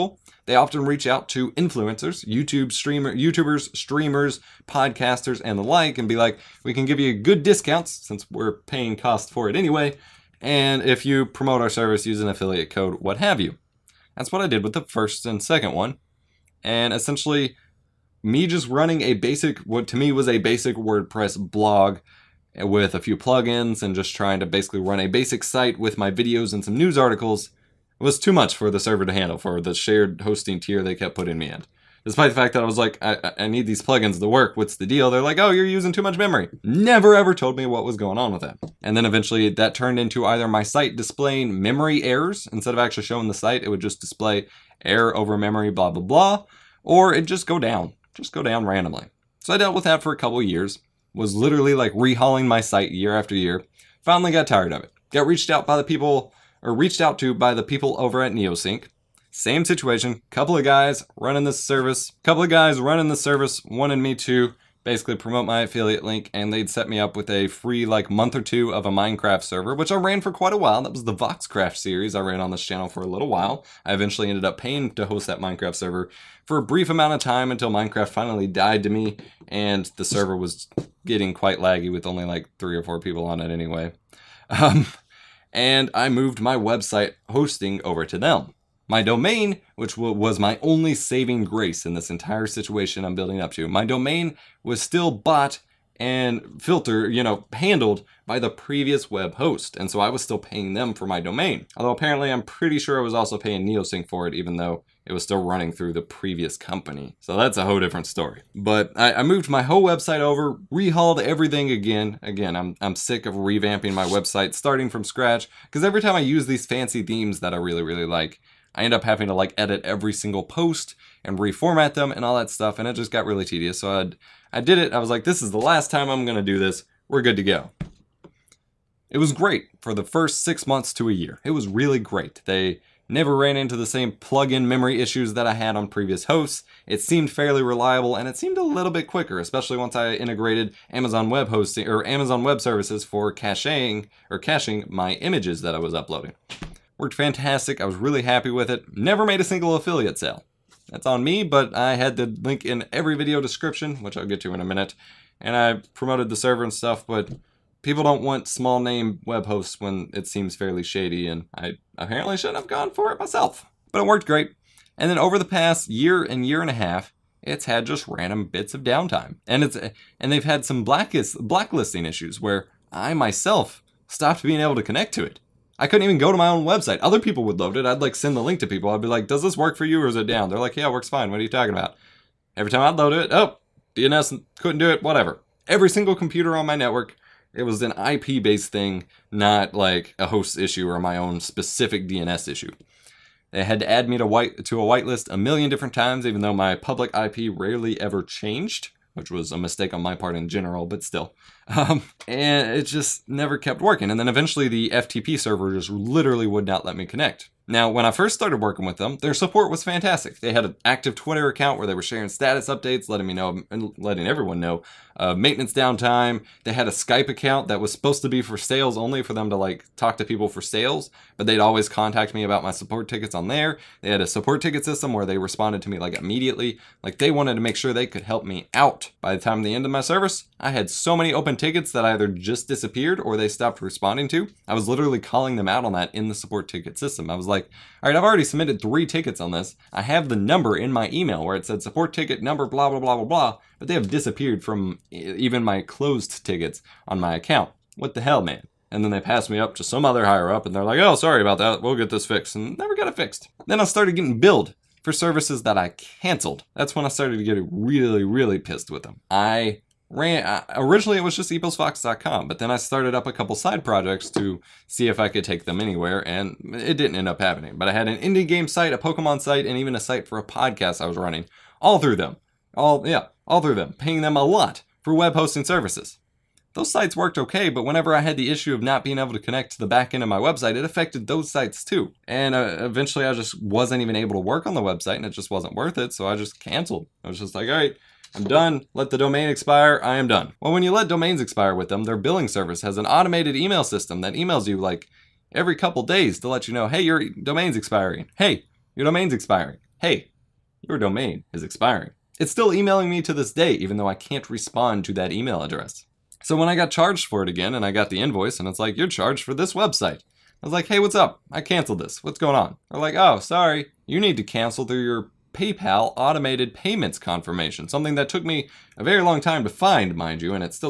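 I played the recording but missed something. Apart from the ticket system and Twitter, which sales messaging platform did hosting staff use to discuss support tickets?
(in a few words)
Skype.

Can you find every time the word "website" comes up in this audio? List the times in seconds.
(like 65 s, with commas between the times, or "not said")
86 s, 109 s, 114 s, 176 s, 280 s, 284 s, 309 s.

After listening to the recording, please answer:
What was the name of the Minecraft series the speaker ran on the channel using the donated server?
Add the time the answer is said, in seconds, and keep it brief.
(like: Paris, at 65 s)
Voxcraft, at 71 s.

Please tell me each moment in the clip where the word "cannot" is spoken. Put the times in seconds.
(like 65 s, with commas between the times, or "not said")
not said.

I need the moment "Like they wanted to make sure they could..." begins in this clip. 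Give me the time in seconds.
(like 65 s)
227 s.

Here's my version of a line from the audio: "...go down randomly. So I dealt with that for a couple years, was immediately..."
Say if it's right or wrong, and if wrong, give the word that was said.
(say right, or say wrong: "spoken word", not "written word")
wrong: "literally", not "immediately".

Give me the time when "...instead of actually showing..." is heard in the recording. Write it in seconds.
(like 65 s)
42 s.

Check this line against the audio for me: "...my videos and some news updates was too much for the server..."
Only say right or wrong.
wrong.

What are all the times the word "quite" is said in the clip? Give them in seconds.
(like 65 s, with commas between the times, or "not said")
70 s, 81 s.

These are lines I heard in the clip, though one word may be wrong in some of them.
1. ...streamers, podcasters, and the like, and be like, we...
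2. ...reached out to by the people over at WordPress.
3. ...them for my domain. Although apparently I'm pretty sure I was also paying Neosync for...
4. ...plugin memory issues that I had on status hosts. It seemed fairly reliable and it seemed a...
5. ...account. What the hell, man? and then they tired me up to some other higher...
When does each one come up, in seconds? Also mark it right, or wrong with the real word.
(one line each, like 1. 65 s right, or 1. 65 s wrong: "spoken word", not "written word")
1. 3 s right
2. 56 s wrong: "Neosync", not "WordPress"
3. 100 s right
4. 134 s wrong: "previous", not "status"
5. 247 s wrong: "passed", not "tired".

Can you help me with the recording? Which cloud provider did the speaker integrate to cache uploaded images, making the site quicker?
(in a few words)
Amazon Web Services.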